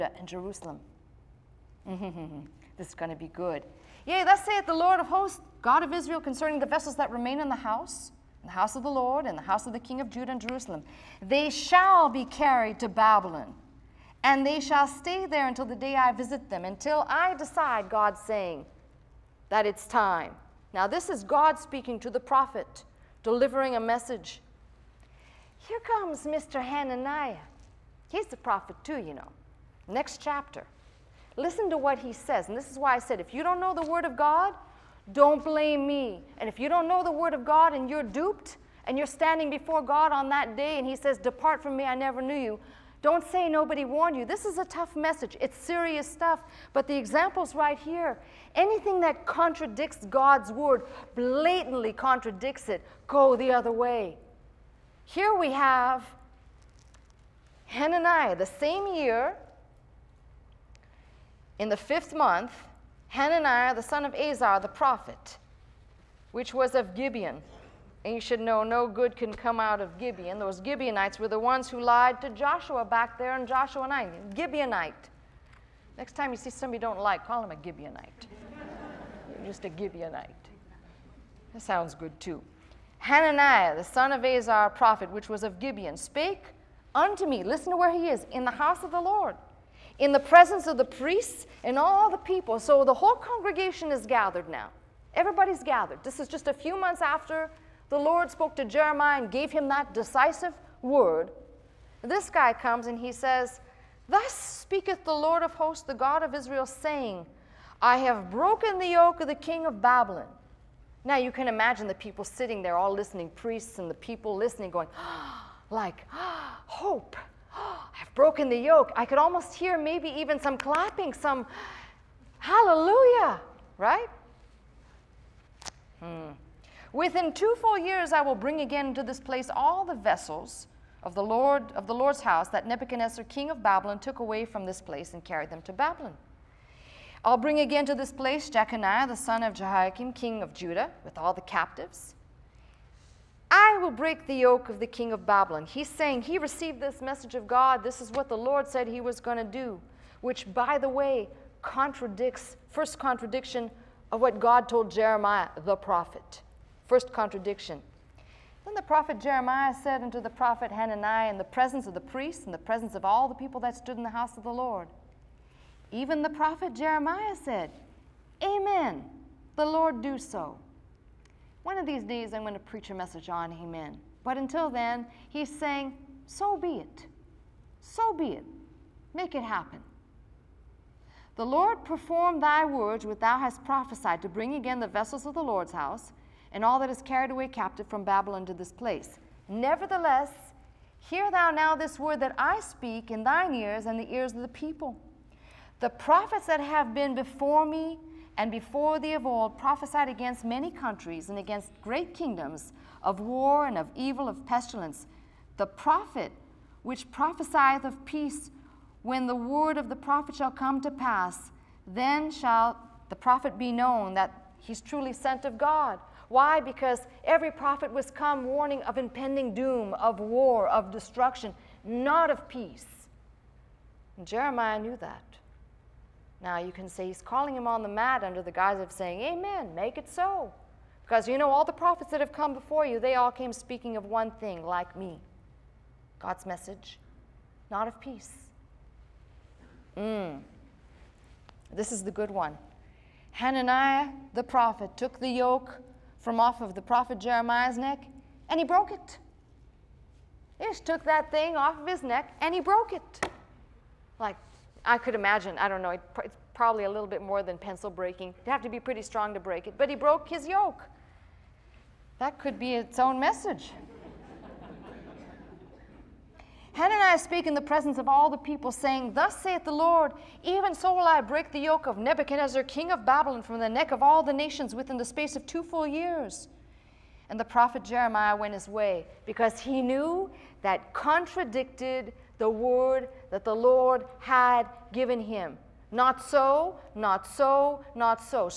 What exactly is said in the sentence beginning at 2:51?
One of these days I'm going to preach a message on Amen.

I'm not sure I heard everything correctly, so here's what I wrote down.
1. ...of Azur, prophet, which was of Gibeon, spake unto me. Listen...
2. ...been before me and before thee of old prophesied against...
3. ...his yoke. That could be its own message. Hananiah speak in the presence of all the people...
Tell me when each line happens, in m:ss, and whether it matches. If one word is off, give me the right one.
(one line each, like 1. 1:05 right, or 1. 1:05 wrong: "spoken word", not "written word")
1. 1:24 right
2. 3:16 right
3. 4:20 right.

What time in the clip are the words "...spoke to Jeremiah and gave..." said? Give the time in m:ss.
1:38.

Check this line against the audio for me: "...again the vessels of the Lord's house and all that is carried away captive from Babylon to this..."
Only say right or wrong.
right.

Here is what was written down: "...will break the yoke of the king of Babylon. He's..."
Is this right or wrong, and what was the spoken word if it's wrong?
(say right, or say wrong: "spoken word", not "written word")
right.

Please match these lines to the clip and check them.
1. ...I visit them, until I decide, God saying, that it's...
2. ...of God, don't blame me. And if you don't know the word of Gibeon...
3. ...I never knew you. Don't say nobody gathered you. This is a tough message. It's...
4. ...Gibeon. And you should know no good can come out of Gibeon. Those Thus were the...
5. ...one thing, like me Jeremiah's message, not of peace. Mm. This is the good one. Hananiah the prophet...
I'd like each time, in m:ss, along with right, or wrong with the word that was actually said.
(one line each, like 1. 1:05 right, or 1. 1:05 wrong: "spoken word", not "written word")
1. 0:15 right
2. 0:34 wrong: "God", not "Gibeon"
3. 0:41 wrong: "warned", not "gathered"
4. 1:06 wrong: "Gibeonites", not "Thus"
5. 3:54 wrong: "God", not "Jeremiah".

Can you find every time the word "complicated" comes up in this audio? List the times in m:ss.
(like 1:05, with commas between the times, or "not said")
not said.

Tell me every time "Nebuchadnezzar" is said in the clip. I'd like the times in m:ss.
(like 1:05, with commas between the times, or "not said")
2:12, 4:31.